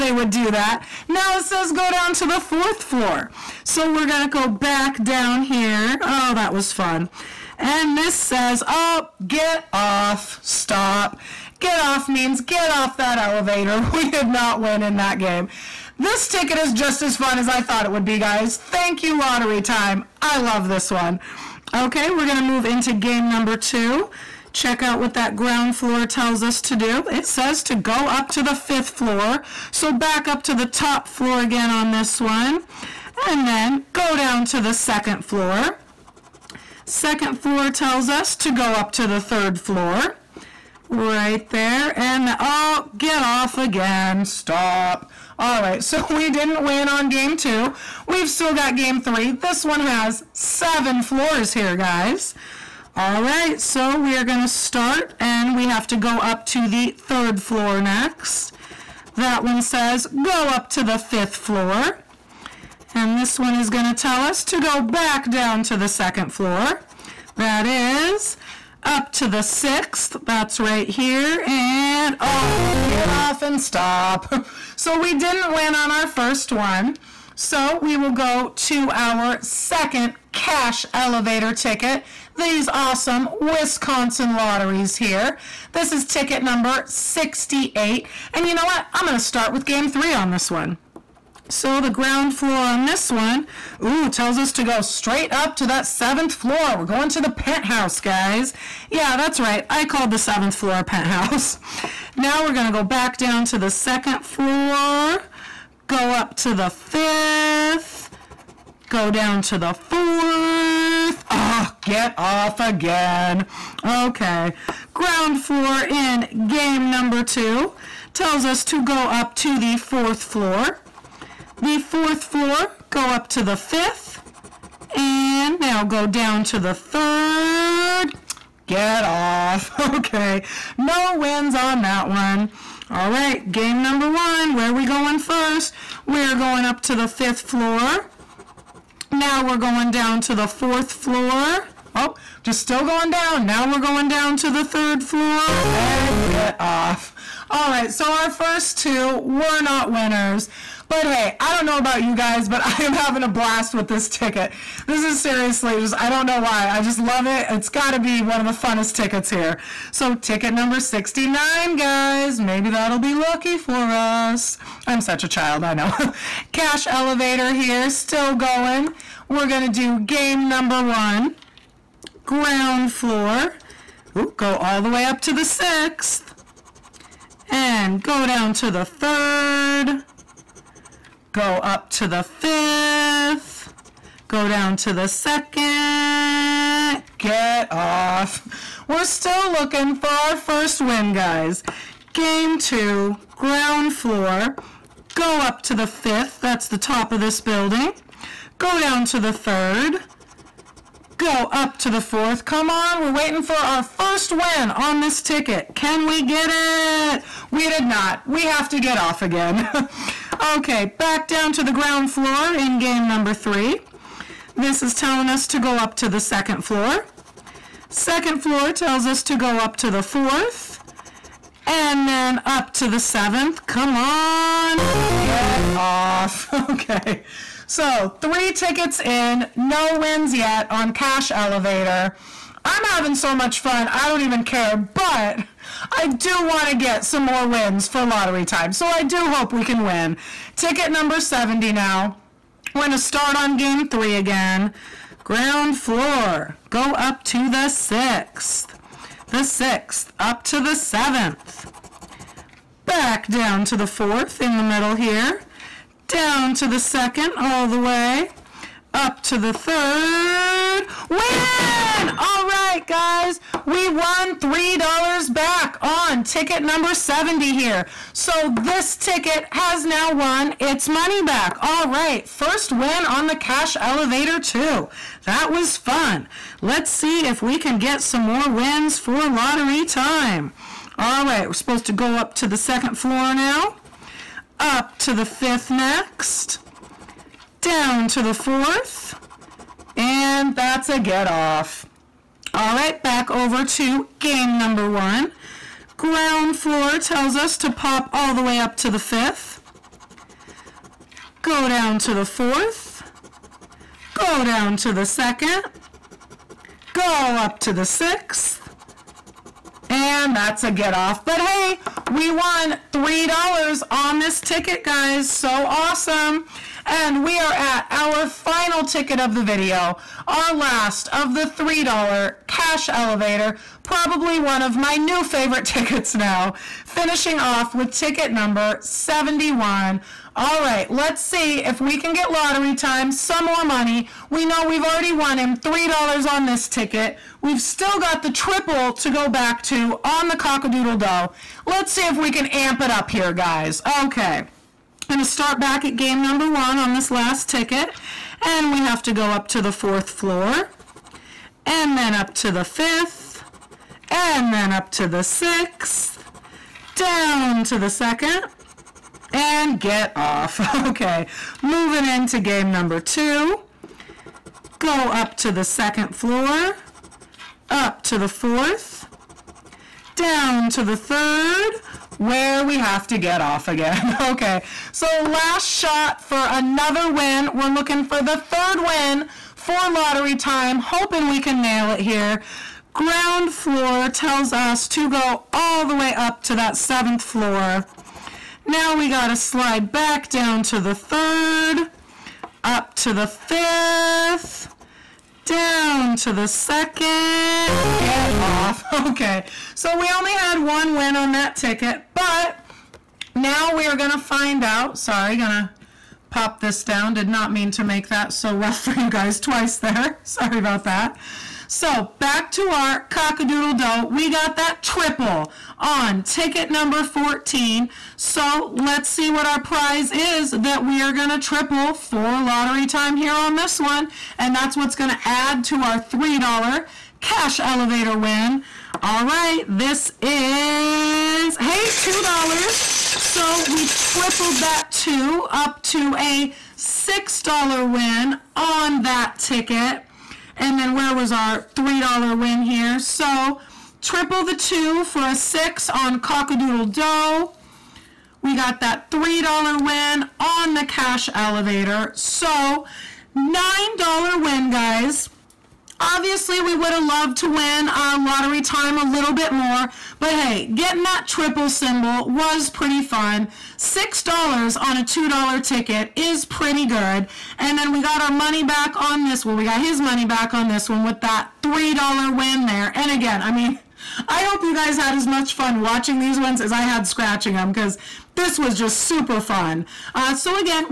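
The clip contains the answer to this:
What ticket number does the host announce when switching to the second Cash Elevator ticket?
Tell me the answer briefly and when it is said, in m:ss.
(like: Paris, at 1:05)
68, at 1:26.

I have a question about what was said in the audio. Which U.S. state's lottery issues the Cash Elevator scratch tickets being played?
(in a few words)
Wisconsin.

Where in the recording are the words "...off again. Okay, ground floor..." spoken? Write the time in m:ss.
1:52.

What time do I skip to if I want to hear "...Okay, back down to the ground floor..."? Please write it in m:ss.
3:30.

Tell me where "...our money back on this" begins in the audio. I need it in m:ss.
7:48.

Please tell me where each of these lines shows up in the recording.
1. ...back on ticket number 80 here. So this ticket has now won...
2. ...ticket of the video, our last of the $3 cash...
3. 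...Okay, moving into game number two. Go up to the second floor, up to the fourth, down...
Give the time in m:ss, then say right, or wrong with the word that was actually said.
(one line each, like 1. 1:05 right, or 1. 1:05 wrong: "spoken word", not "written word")
1. 4:25 wrong: "70", not "80"
2. 5:18 right
3. 6:00 right.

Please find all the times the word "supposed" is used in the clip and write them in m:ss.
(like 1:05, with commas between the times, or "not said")
4:41.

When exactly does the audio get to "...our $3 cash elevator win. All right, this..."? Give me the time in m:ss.
7:05.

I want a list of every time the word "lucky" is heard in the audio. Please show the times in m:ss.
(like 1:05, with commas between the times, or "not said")
2:43.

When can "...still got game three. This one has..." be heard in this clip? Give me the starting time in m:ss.
0:48.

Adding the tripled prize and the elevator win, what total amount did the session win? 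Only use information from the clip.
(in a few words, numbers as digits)
$9.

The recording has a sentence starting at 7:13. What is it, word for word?
So we tripled that two up to a $6 win on that ticket.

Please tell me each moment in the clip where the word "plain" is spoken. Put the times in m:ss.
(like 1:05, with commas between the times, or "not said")
not said.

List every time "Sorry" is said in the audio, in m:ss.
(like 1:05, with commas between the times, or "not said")
6:44, 6:50.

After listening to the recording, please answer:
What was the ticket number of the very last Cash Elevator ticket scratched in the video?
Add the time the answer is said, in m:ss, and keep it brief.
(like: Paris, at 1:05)
71, at 5:27.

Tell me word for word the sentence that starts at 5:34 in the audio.
We know we've already won him $3 on this ticket.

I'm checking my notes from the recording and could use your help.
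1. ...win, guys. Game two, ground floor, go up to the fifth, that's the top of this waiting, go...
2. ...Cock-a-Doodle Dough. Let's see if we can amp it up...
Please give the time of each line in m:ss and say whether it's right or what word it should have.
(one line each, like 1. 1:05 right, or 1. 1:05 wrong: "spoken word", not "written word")
1. 3:10 wrong: "building", not "waiting"
2. 5:40 right.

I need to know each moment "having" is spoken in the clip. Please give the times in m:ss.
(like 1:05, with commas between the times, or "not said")
2:32, 3:52.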